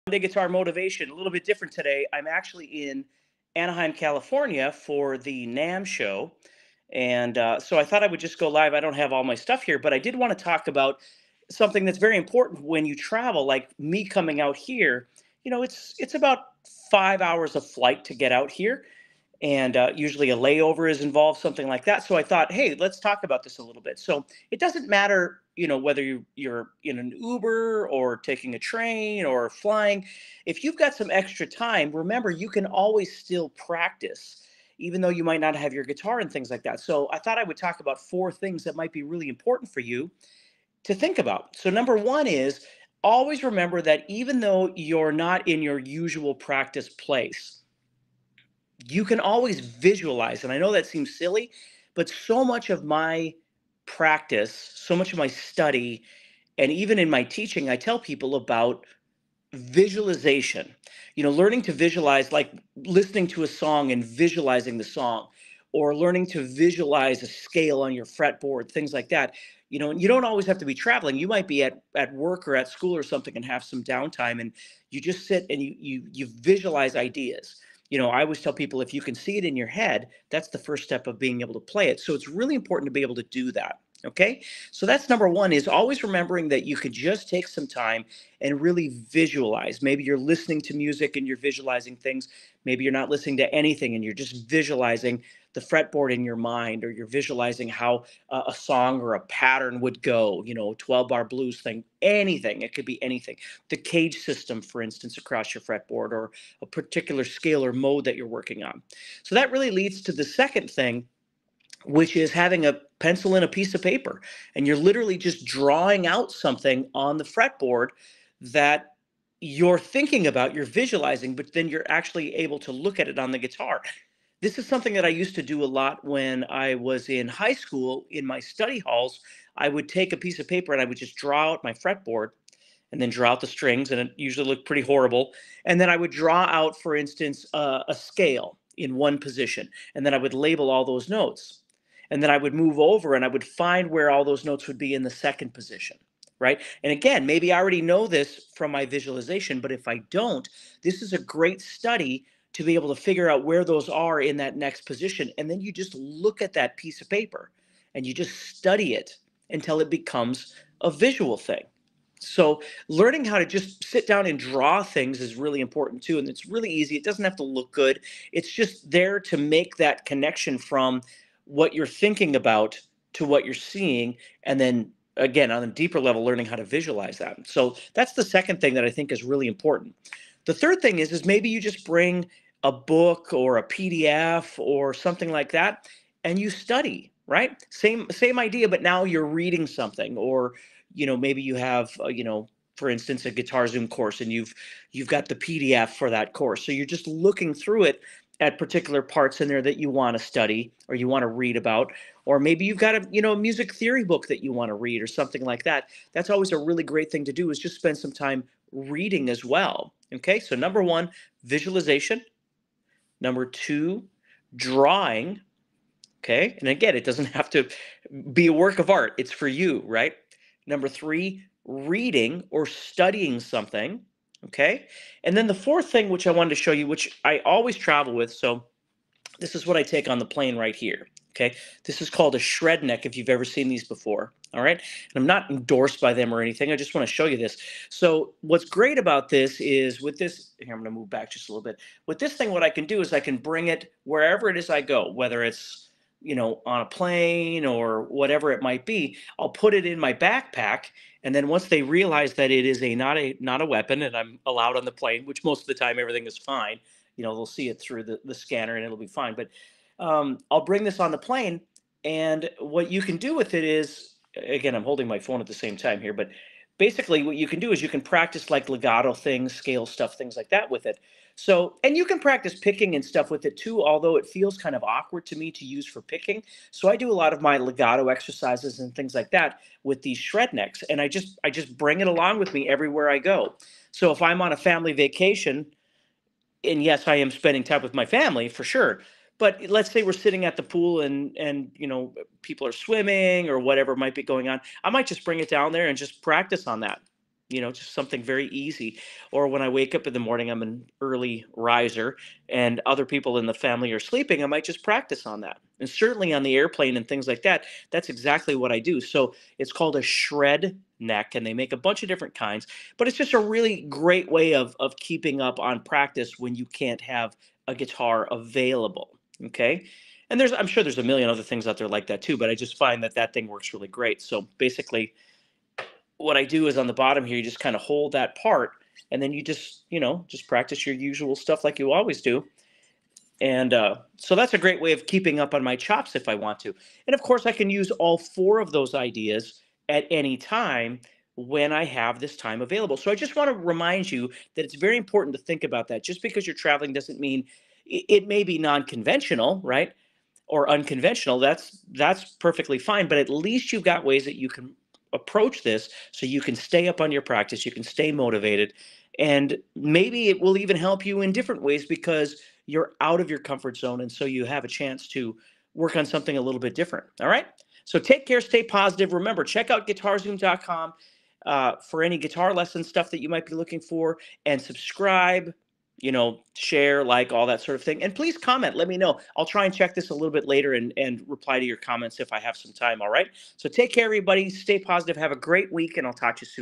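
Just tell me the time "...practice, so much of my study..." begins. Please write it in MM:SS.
00:53.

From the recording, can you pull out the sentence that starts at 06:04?
And so you have a chance to work on something a little bit different.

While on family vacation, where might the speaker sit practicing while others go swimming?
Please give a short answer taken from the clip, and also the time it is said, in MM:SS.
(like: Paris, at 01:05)
The pool, at 04:50.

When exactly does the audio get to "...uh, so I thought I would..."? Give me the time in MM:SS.
00:07.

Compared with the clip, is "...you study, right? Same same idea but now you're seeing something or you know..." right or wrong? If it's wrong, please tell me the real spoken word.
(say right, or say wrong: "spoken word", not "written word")
wrong: "reading", not "seeing".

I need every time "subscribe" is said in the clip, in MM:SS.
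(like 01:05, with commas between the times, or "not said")
06:14.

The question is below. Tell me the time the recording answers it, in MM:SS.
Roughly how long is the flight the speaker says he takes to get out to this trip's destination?
00:16.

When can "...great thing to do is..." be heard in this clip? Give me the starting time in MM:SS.
03:26.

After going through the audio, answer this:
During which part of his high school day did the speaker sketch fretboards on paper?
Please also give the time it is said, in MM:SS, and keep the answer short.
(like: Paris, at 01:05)
Study halls, at 02:08.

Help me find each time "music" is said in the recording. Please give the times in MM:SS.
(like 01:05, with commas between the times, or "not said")
01:30, 03:23.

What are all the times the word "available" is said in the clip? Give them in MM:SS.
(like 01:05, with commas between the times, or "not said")
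05:18, 05:42.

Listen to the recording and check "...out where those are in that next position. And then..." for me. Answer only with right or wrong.
right.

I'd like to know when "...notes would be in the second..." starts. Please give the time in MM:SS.
02:24.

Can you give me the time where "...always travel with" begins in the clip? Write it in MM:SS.
03:47.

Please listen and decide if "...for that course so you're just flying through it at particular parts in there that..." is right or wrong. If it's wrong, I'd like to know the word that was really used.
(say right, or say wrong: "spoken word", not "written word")
wrong: "looking", not "flying".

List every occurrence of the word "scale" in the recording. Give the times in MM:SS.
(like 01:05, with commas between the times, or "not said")
01:07, 01:47, 02:17, 04:29.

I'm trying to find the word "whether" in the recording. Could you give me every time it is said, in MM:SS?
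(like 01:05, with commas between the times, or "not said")
00:25, 04:05.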